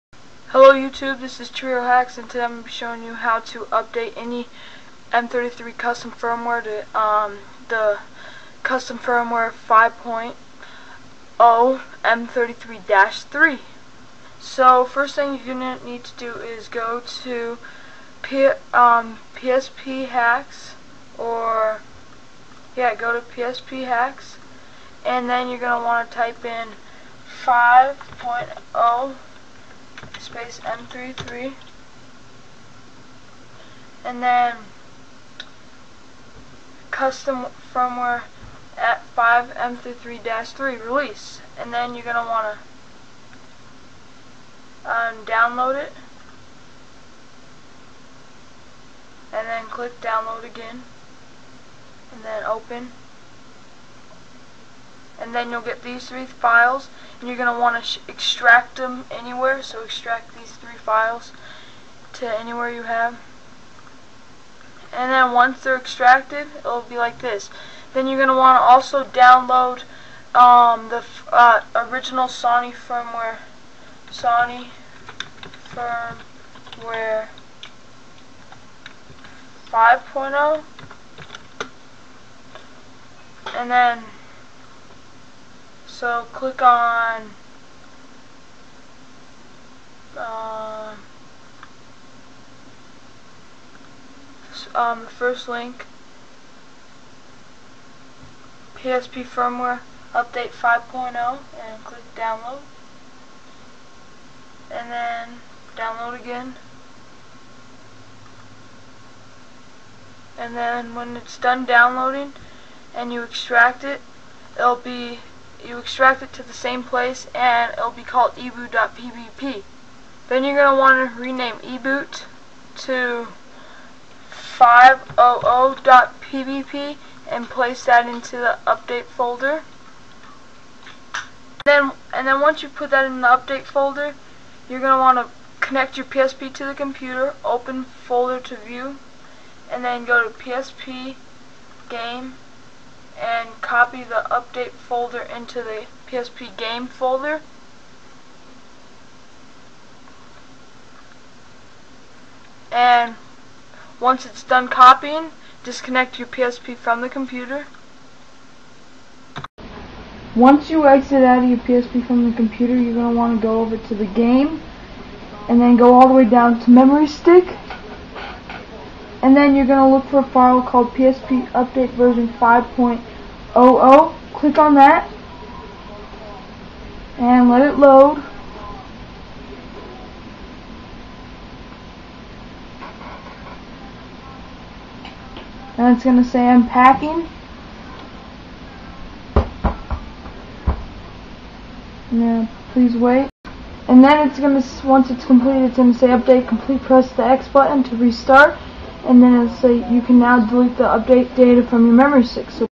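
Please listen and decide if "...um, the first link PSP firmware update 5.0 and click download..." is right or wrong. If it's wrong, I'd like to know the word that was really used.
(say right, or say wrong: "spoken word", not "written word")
right.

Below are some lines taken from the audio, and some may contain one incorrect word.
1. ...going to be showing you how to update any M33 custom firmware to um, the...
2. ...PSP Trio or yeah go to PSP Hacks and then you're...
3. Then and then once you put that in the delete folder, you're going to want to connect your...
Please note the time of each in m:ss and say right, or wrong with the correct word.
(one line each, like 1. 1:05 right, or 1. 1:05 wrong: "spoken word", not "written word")
1. 0:02 right
2. 0:19 wrong: "Hacks", not "Trio"
3. 2:11 wrong: "update", not "delete".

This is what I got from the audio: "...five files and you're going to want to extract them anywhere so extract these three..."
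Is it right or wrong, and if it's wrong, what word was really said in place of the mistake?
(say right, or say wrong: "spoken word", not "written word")
wrong: "three", not "five".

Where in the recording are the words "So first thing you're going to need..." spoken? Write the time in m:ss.
0:14.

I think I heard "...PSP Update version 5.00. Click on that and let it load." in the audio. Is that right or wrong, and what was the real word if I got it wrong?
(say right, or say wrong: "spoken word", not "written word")
right.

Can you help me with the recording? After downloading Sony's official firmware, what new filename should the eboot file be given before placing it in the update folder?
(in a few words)
500.pbp.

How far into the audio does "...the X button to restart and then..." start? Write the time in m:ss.
3:17.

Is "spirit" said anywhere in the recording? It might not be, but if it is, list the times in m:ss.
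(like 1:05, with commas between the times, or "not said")
not said.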